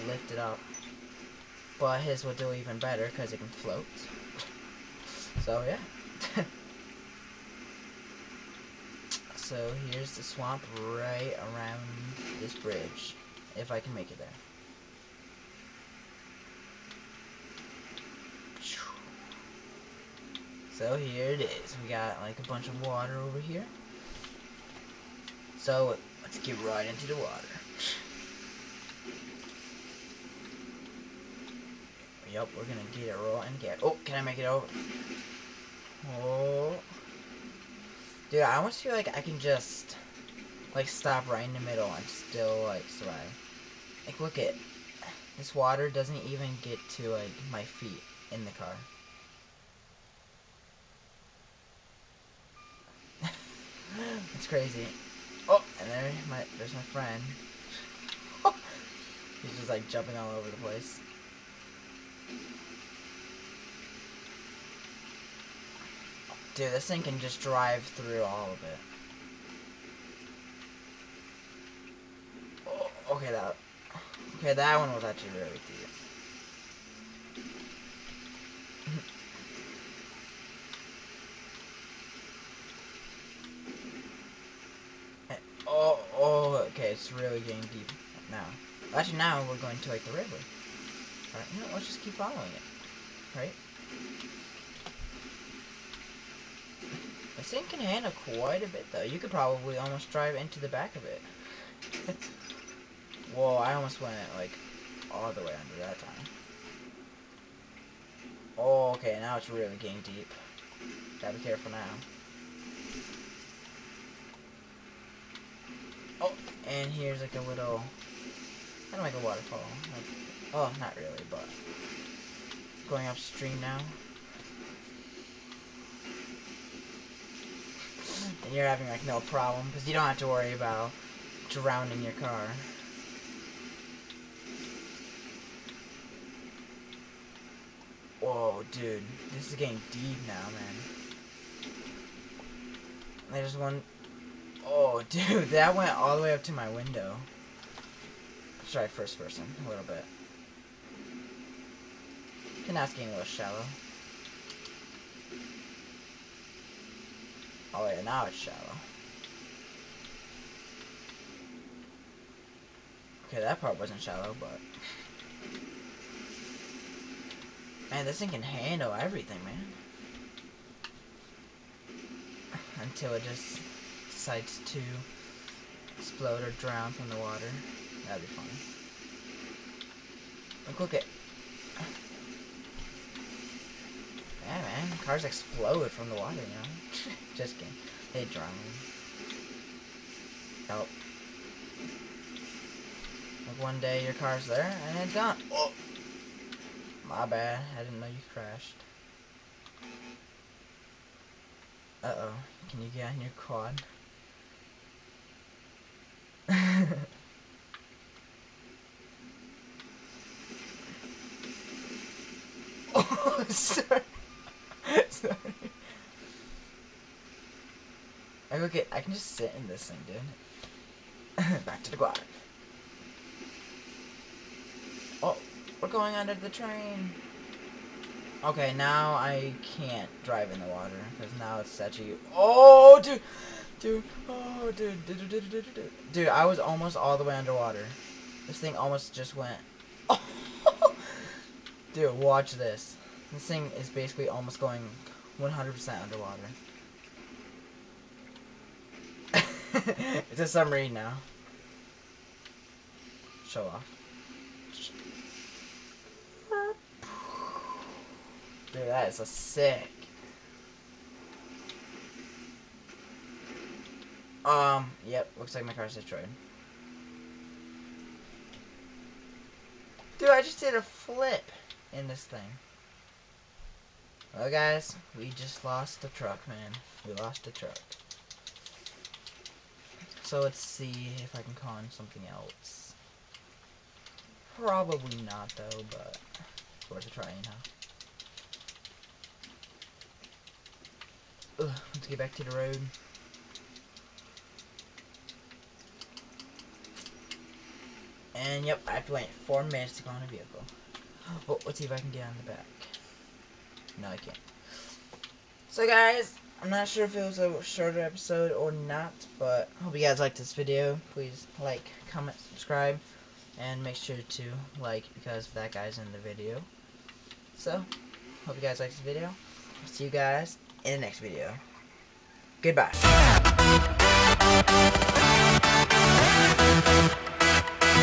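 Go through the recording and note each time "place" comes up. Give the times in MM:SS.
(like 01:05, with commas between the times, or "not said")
01:00.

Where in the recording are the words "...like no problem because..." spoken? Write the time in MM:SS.
02:08.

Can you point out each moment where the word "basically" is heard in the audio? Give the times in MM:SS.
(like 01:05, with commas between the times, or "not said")
04:03.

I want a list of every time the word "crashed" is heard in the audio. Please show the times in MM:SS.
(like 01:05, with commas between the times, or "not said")
03:18.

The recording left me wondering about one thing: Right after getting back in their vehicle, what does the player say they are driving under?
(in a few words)
the train.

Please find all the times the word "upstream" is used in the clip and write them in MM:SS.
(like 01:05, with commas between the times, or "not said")
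02:03.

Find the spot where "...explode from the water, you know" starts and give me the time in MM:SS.
03:05.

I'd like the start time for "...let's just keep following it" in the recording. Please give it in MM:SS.
01:31.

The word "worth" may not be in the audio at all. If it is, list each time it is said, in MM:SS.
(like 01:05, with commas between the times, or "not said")
04:46.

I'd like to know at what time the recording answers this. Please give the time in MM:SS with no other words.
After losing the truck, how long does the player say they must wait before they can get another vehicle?
04:59.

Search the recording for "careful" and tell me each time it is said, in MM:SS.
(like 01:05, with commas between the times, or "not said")
01:51.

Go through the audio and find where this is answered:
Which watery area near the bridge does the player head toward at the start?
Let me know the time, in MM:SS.
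00:10.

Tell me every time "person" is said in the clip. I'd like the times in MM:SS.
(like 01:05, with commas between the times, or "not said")
02:29.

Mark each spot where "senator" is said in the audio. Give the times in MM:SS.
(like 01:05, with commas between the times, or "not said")
not said.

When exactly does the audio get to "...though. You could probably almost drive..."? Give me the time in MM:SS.
01:38.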